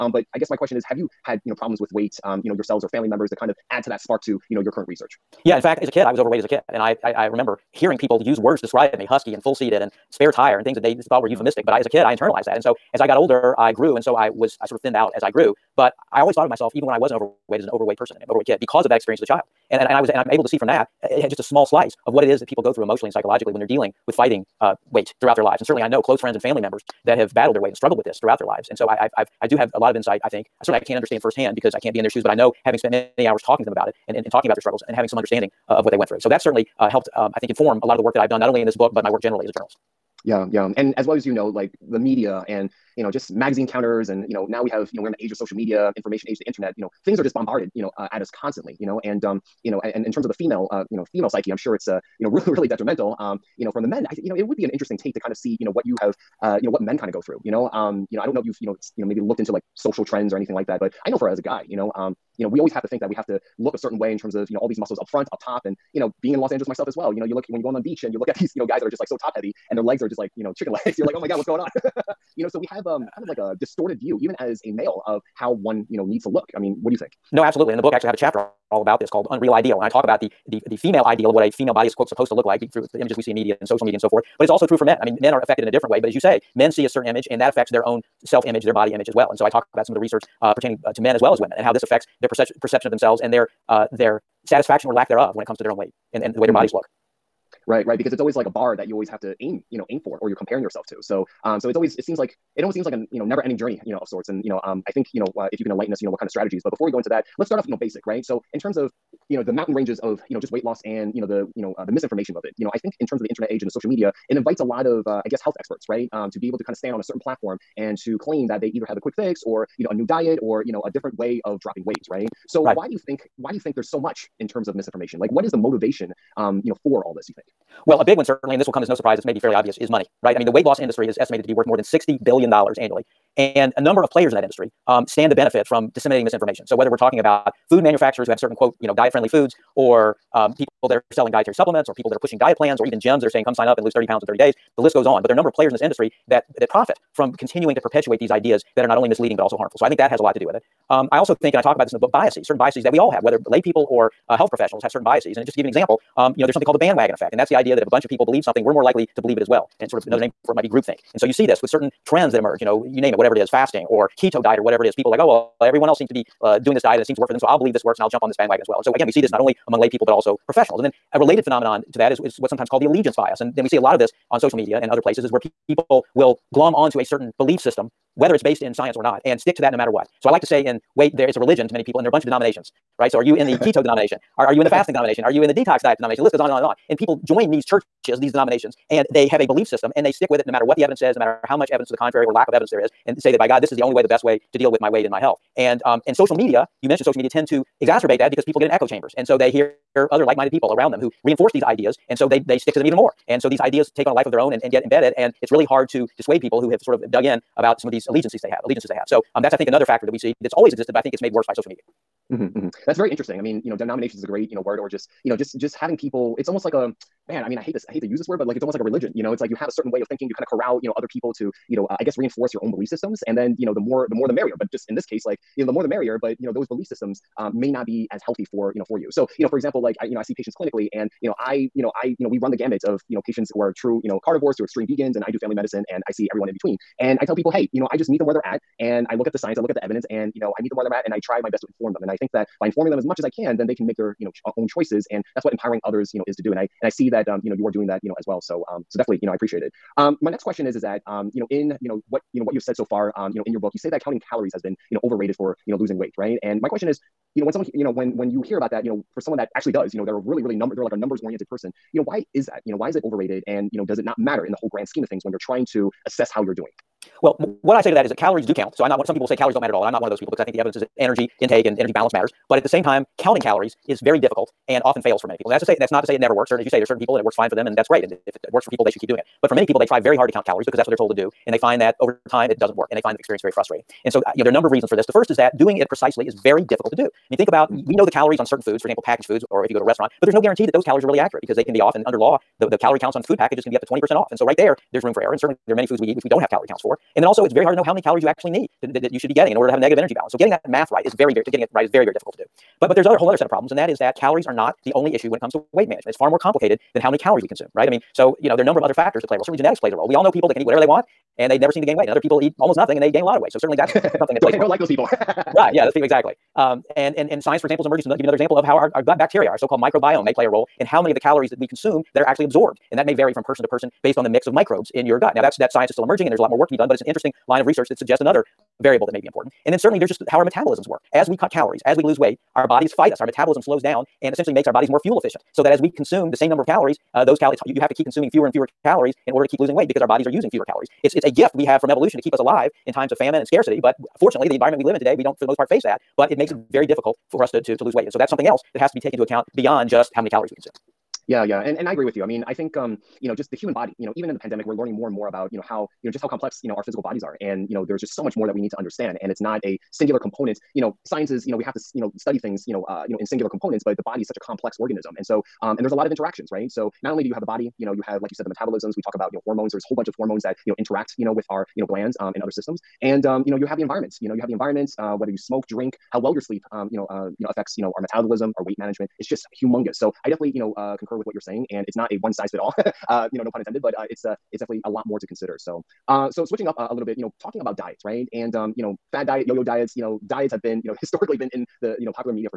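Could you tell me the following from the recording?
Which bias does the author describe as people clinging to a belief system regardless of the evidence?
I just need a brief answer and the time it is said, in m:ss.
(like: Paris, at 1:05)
allegiance bias, at 2:52.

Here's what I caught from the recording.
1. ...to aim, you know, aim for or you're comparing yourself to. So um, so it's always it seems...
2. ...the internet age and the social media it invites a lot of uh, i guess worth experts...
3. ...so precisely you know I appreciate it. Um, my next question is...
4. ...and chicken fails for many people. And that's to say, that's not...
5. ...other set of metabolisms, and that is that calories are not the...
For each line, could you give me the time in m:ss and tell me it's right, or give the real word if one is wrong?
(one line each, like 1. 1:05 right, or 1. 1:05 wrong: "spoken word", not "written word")
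1. 1:39 right
2. 1:53 wrong: "health", not "worth"
3. 4:08 wrong: "definitely", not "precisely"
4. 4:34 wrong: "often", not "chicken"
5. 5:03 wrong: "problems", not "metabolisms".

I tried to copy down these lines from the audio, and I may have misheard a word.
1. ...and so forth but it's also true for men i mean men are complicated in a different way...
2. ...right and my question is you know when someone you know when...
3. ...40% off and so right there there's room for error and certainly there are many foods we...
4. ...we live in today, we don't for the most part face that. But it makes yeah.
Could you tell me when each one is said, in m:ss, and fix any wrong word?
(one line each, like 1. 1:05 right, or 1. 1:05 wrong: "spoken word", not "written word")
1. 1:23 wrong: "affected", not "complicated"
2. 4:16 right
3. 4:53 wrong: "20", not "40"
4. 5:44 right.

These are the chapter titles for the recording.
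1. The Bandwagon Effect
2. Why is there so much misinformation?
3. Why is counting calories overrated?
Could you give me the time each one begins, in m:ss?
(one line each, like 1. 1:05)
1. 2:36
2. 2:02
3. 4:15.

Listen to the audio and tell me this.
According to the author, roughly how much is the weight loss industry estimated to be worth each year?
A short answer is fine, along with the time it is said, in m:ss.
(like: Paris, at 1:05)
more than 60 billion dollars, at 2:11.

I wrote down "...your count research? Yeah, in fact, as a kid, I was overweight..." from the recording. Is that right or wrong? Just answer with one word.
wrong.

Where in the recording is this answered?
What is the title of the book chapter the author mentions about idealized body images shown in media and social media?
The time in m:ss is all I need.
1:19.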